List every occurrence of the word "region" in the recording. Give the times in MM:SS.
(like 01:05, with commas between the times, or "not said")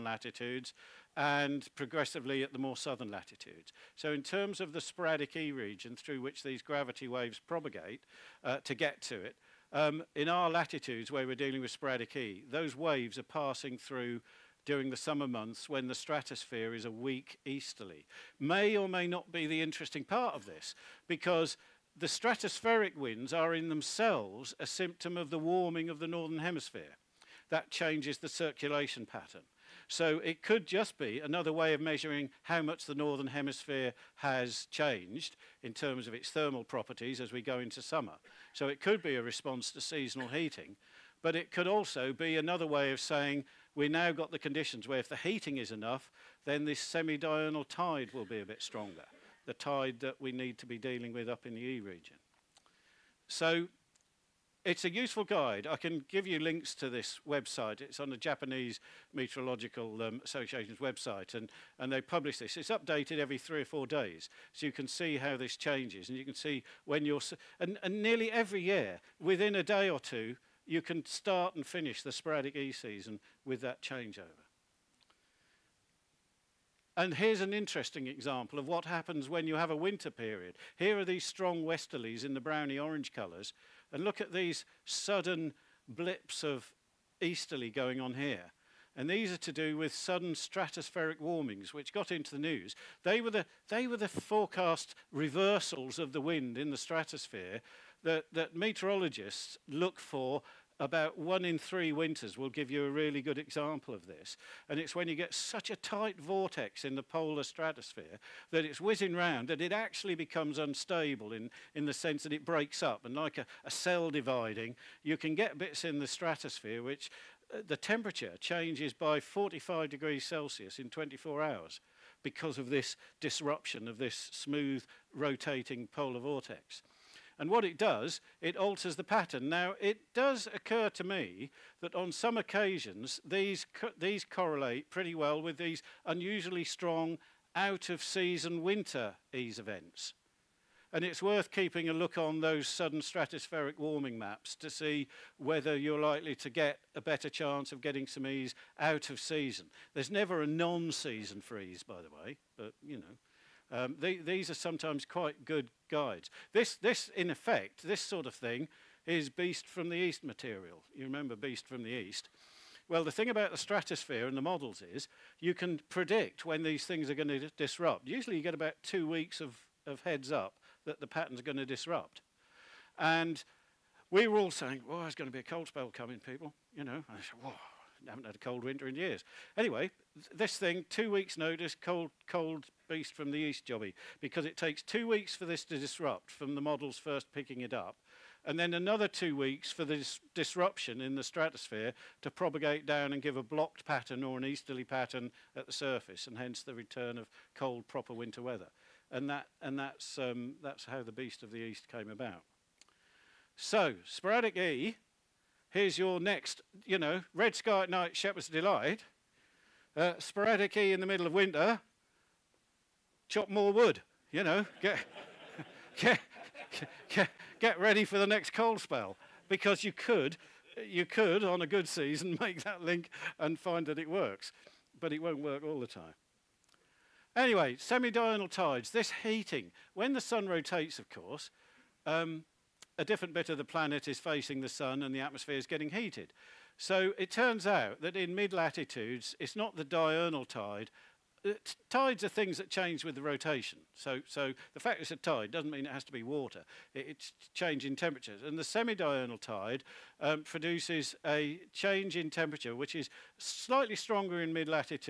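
00:05, 00:51.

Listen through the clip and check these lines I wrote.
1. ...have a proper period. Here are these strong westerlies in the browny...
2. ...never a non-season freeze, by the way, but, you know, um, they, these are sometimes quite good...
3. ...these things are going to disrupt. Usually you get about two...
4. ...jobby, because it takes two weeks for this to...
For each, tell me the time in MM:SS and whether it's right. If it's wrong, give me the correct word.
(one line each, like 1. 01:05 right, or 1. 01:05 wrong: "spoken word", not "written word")
1. 01:19 wrong: "winter", not "proper"
2. 02:30 right
3. 02:46 right
4. 03:03 right.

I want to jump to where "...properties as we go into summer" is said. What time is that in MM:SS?
00:36.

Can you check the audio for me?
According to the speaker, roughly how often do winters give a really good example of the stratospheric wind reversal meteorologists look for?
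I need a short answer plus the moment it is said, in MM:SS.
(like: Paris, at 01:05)
One in three winters, at 01:41.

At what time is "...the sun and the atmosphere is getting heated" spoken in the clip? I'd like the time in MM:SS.
03:54.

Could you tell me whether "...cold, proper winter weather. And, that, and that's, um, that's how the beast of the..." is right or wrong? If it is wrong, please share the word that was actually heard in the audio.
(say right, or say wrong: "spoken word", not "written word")
right.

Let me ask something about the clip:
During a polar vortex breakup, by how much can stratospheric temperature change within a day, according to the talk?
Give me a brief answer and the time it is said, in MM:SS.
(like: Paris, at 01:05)
45 degrees Celsius, at 01:59.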